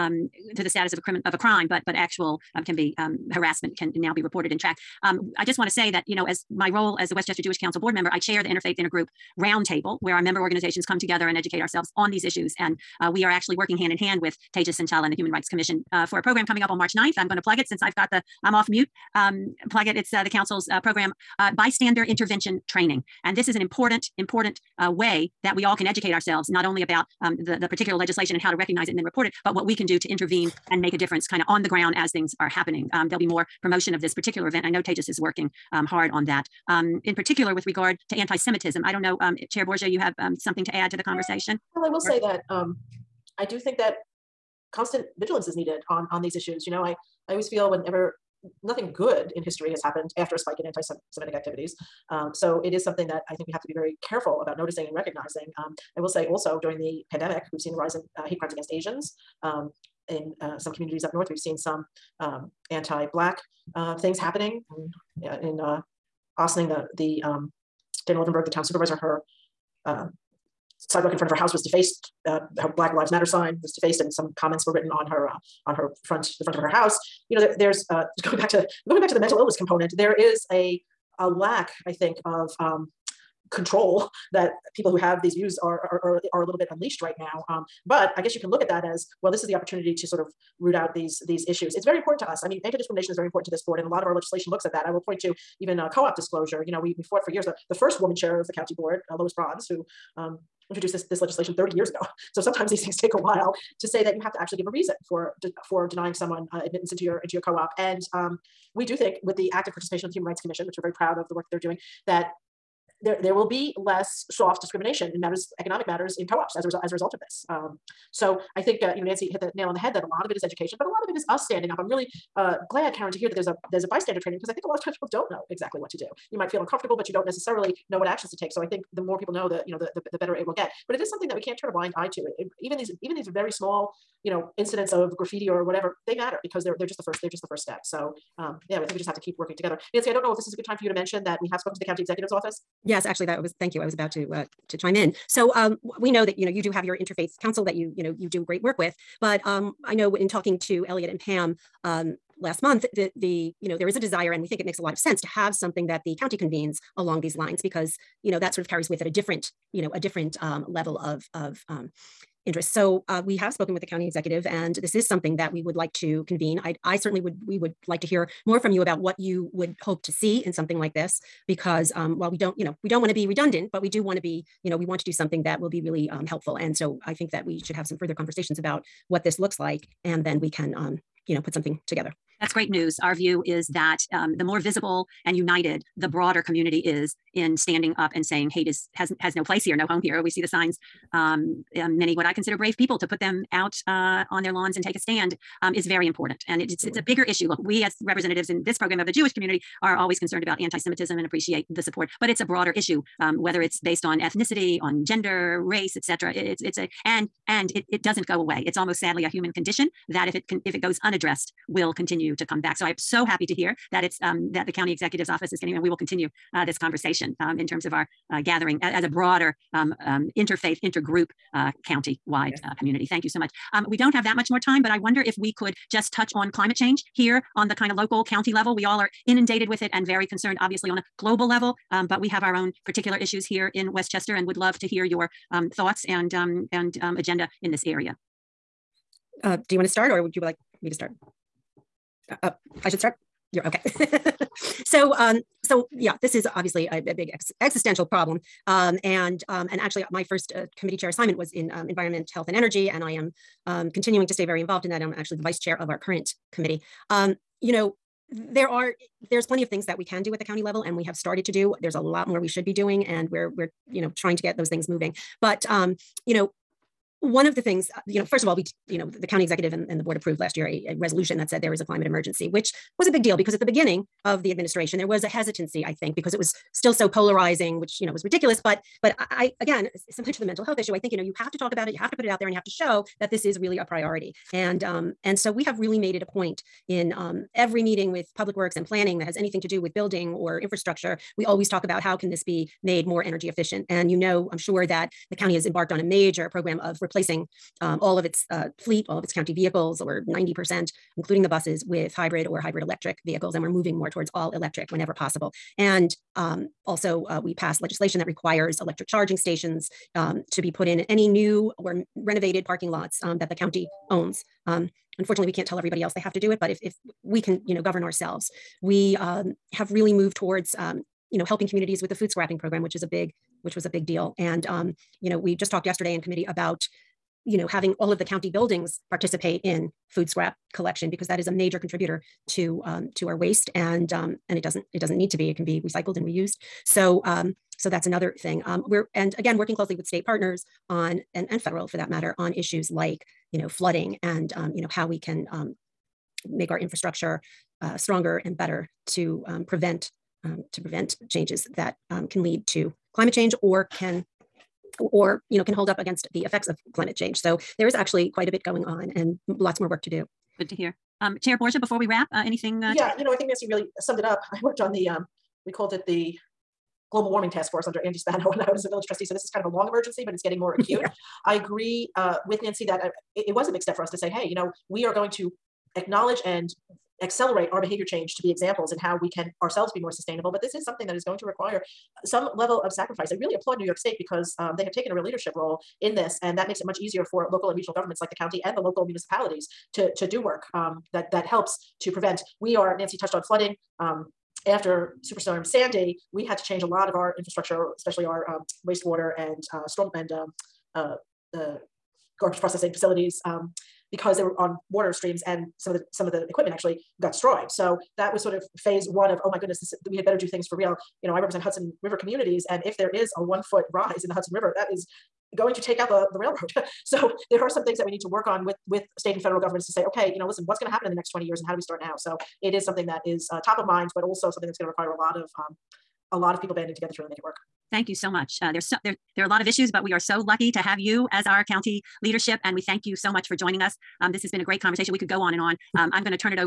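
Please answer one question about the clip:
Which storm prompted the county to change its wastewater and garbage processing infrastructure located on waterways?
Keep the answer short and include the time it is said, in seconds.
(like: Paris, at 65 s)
Superstorm Sandy, at 395 s.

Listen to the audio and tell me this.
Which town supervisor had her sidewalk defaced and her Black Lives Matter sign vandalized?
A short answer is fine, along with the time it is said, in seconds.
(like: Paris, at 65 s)
Dana Levenberg, at 68 s.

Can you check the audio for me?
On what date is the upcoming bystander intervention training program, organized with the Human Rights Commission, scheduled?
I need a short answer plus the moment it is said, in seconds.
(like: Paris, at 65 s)
March 9th, at 16 s.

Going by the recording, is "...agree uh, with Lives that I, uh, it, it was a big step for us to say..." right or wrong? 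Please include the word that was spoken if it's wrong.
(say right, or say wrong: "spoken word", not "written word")
wrong: "Nancy", not "Lives".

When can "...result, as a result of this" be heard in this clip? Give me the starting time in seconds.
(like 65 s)
116 s.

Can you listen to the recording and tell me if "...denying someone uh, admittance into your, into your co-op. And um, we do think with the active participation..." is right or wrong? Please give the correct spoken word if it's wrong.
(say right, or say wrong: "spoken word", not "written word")
right.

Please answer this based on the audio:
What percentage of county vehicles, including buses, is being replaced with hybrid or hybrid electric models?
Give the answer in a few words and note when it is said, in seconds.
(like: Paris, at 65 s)
90%, at 300 s.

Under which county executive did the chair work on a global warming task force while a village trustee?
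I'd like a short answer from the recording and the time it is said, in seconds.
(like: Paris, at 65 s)
Andy Spano, at 368 s.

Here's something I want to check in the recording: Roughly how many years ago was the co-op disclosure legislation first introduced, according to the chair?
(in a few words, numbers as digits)
30 years.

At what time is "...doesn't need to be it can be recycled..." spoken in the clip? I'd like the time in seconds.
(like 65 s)
334 s.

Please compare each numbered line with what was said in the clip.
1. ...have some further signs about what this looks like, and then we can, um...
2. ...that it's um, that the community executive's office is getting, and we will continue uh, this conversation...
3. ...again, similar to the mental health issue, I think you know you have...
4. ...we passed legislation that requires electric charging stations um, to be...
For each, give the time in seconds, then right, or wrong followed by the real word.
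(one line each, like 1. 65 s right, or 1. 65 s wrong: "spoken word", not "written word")
1. 177 s wrong: "conversations", not "signs"
2. 213 s wrong: "county", not "community"
3. 279 s right
4. 307 s right.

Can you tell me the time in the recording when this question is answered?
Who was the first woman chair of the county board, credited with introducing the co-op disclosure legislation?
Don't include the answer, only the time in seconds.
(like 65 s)
99 s.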